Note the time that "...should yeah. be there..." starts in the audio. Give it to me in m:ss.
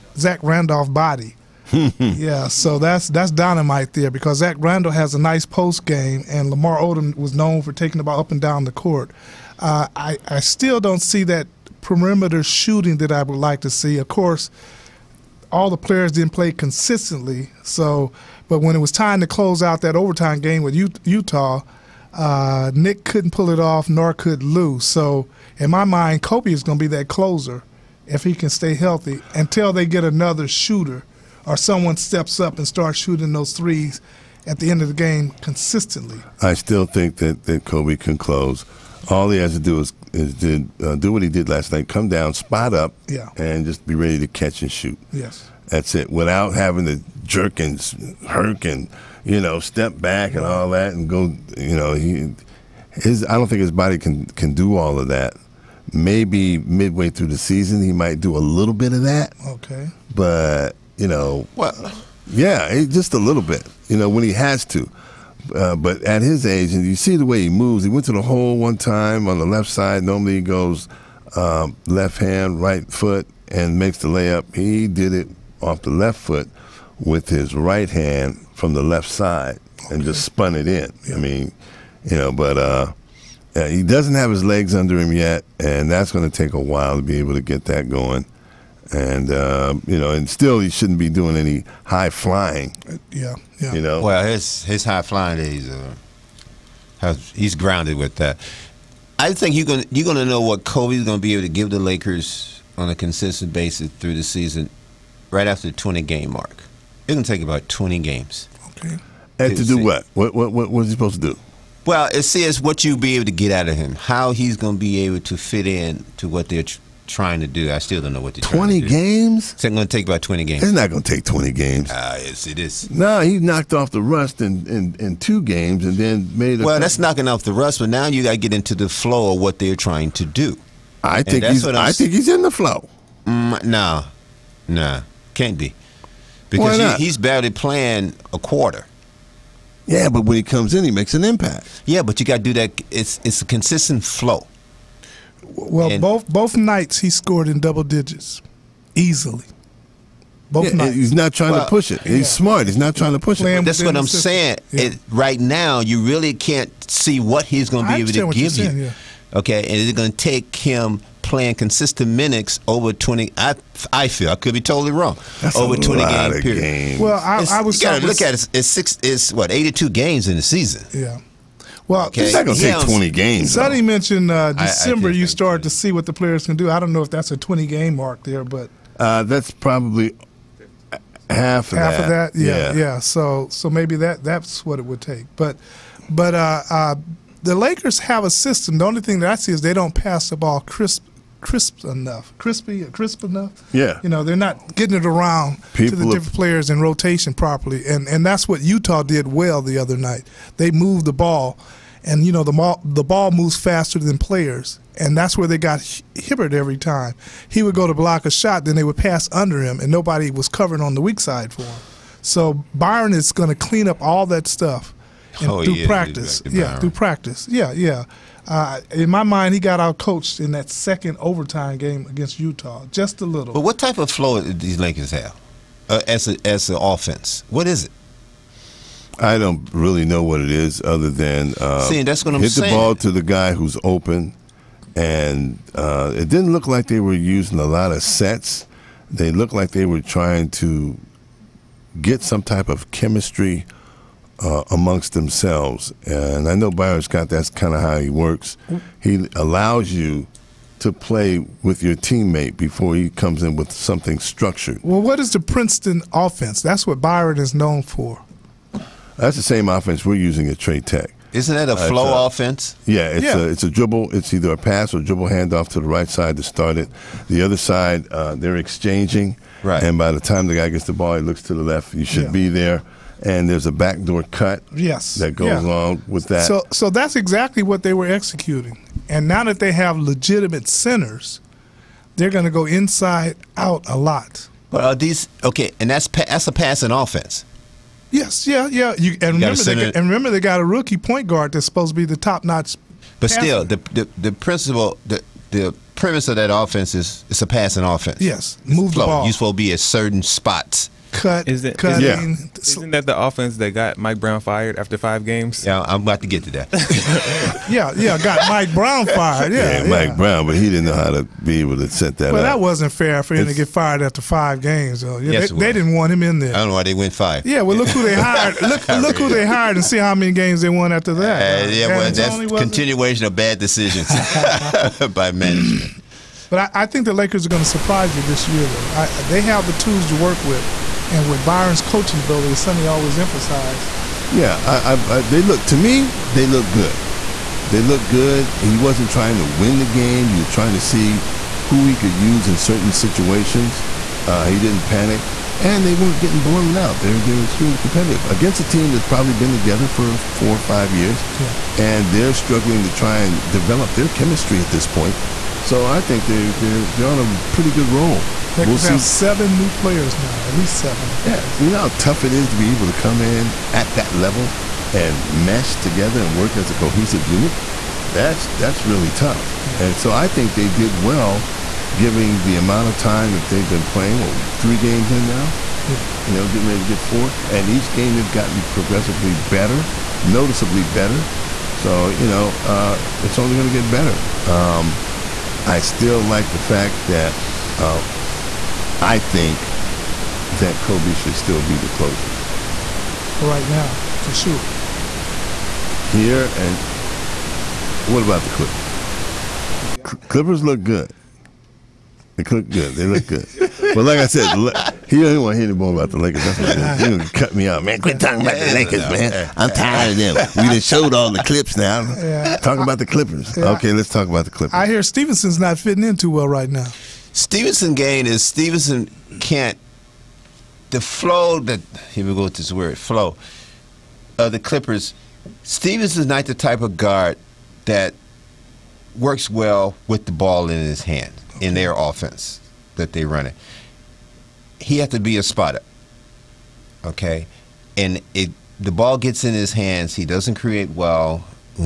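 4:32.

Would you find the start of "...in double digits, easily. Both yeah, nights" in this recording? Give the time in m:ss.
2:27.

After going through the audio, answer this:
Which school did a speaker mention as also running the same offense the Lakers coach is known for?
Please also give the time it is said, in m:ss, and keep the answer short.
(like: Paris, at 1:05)
Trey Tech, at 4:20.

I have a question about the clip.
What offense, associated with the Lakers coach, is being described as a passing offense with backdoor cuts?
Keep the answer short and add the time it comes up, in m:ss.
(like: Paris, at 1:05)
Princeton offense, at 4:15.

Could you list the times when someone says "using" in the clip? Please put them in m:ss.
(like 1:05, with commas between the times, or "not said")
3:57, 4:20.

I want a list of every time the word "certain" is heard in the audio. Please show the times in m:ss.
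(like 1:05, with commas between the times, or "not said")
4:59, 5:42.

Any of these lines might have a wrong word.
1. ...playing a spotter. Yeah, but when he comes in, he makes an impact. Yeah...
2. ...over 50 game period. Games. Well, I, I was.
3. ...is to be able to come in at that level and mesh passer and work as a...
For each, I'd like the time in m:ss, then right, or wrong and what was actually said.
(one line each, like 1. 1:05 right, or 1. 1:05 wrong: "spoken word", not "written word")
1. 2:17 wrong: "quarter", not "spotter"
2. 2:45 wrong: "20", not "50"
3. 6:02 wrong: "together", not "passer".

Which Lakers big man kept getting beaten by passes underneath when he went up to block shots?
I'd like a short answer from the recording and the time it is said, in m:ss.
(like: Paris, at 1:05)
Hibbert, at 3:26.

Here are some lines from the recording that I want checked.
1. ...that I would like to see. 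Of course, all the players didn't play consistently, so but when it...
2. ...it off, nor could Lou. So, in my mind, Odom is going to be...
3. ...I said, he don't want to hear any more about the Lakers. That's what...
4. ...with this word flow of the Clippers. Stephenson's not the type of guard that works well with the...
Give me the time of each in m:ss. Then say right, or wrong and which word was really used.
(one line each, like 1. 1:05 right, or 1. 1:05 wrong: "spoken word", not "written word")
1. 0:12 right
2. 0:23 wrong: "Kobe", not "Odom"
3. 6:44 right
4. 7:02 right.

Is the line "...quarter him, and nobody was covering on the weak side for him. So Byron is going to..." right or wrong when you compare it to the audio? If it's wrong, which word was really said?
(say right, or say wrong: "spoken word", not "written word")
wrong: "under", not "quarter".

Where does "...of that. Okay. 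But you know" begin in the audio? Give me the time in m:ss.
0:58.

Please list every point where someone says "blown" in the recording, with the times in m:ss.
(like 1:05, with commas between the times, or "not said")
5:46.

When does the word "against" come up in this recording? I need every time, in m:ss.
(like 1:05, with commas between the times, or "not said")
3:42, 5:48.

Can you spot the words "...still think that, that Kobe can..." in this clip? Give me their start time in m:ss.
0:36.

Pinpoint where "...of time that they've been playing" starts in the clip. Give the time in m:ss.
6:12.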